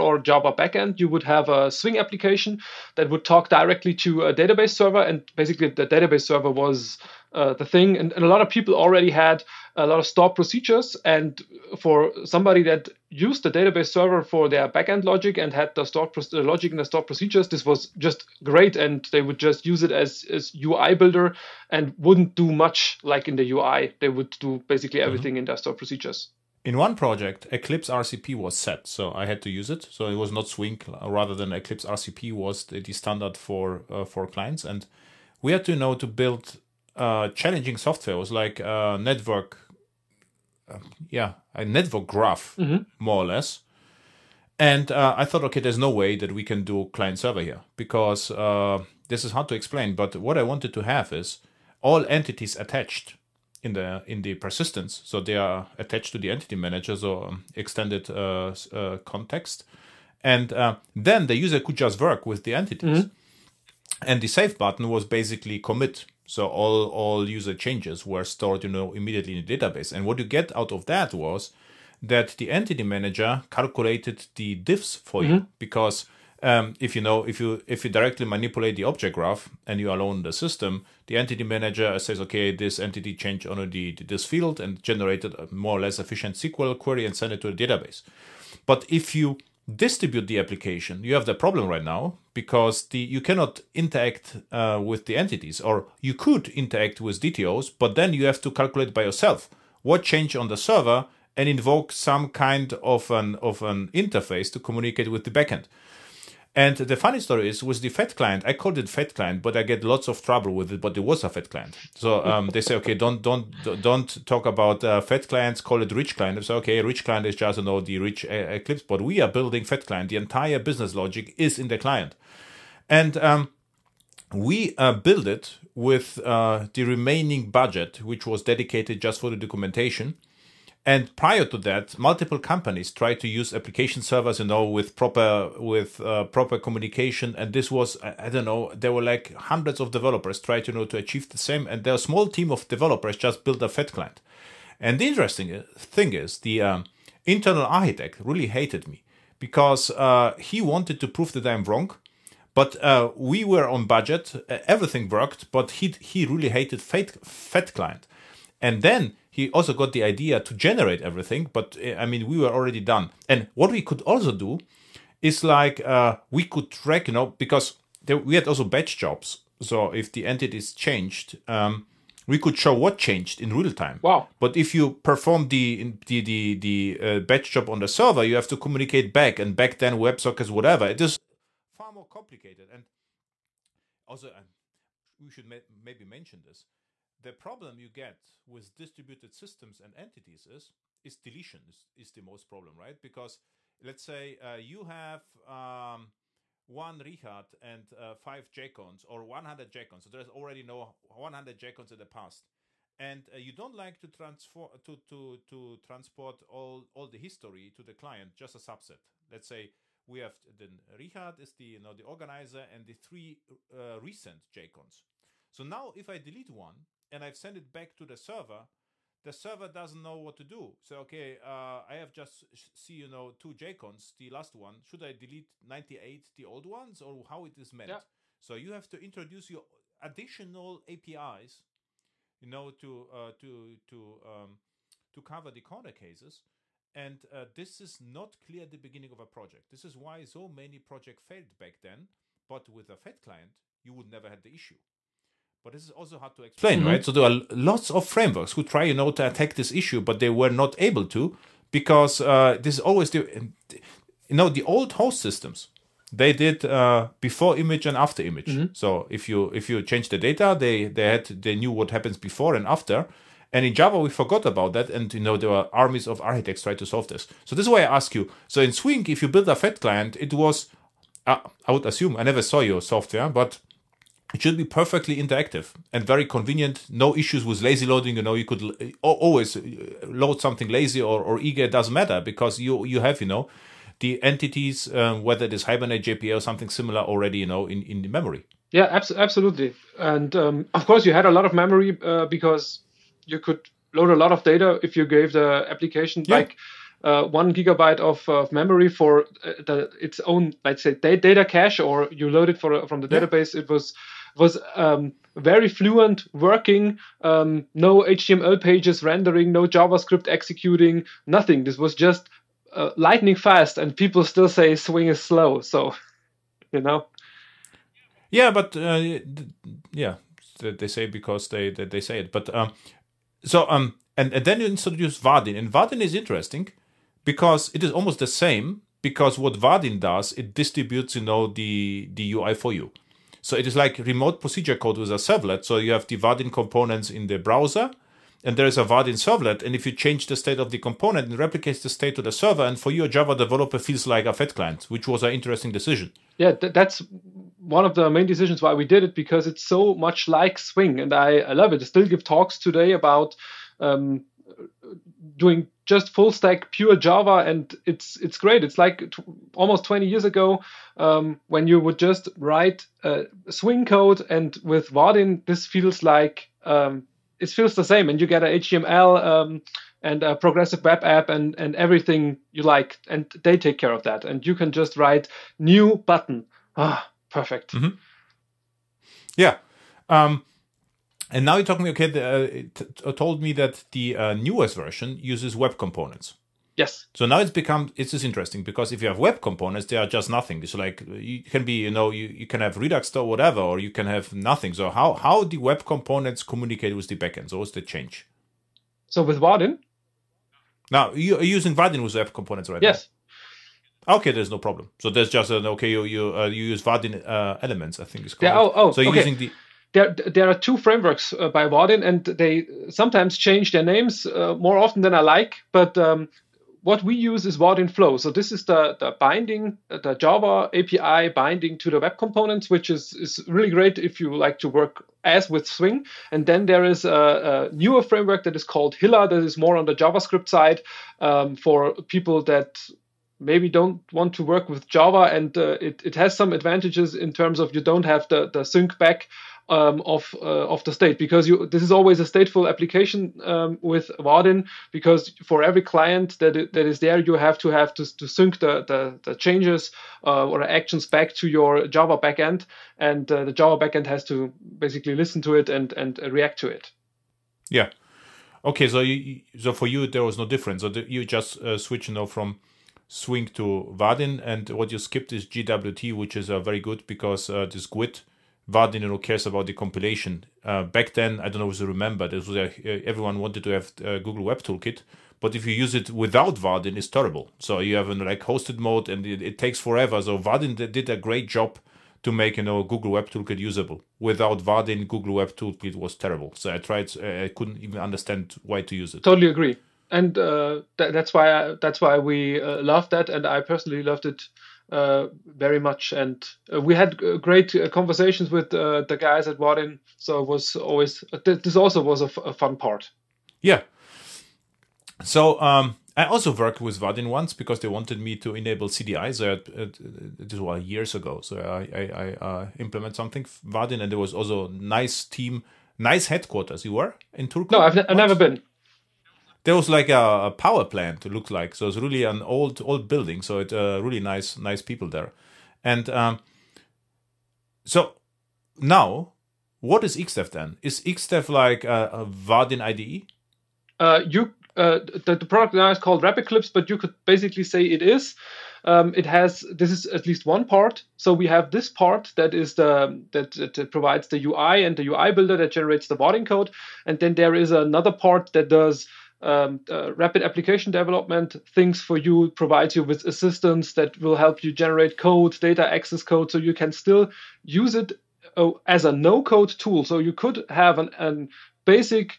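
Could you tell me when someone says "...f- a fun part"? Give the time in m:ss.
8:22.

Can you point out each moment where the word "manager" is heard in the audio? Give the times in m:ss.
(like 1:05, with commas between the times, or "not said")
0:56, 1:12, 1:21.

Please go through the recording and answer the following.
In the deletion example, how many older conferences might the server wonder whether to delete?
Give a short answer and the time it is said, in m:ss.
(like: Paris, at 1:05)
98, at 3:45.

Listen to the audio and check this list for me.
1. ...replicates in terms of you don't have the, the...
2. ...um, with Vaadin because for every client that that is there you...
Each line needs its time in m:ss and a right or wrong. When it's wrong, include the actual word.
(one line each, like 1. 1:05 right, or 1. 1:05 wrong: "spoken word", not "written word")
1. 7:16 wrong: "advantages", not "replicates"
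2. 7:23 right.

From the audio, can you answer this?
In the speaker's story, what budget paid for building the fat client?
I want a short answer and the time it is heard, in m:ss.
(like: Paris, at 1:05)
documentation, at 2:09.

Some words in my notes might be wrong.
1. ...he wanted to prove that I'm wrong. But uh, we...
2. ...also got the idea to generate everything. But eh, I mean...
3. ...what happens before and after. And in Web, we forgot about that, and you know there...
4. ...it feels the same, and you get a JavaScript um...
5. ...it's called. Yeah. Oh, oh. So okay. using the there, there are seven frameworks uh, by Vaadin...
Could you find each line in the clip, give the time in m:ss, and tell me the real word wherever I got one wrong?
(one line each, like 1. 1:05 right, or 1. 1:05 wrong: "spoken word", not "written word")
1. 2:30 right
2. 2:39 right
3. 4:21 wrong: "Java", not "Web"
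4. 6:07 wrong: "HTML", not "JavaScript"
5. 6:48 wrong: "two", not "seven".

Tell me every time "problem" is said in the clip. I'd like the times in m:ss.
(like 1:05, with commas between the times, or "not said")
1:31, 3:07, 3:12, 6:44.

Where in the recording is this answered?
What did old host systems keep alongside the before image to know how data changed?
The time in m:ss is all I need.
4:17.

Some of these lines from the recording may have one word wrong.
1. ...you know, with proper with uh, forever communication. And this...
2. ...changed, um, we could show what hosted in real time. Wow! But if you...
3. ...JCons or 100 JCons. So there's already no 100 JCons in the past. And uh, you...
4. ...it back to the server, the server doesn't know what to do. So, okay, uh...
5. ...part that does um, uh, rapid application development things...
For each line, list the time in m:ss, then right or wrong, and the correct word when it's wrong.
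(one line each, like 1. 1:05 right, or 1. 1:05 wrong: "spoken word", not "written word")
1. 2:14 wrong: "proper", not "forever"
2. 2:50 wrong: "changed", not "hosted"
3. 3:18 right
4. 3:37 right
5. 9:08 right.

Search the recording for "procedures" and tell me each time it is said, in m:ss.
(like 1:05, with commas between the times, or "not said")
0:10, 0:17, 0:25, 5:34.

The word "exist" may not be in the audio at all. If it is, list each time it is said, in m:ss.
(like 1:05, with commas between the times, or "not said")
not said.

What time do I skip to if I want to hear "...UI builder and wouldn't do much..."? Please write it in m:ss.
0:20.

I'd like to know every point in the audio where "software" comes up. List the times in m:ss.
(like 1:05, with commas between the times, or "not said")
0:37, 4:32.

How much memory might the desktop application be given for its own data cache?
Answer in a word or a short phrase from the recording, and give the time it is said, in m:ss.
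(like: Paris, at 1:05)
1 gigabyte, at 4:57.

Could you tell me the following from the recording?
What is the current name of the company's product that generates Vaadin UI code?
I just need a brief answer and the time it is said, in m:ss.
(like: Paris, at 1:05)
RapidClipse, at 8:56.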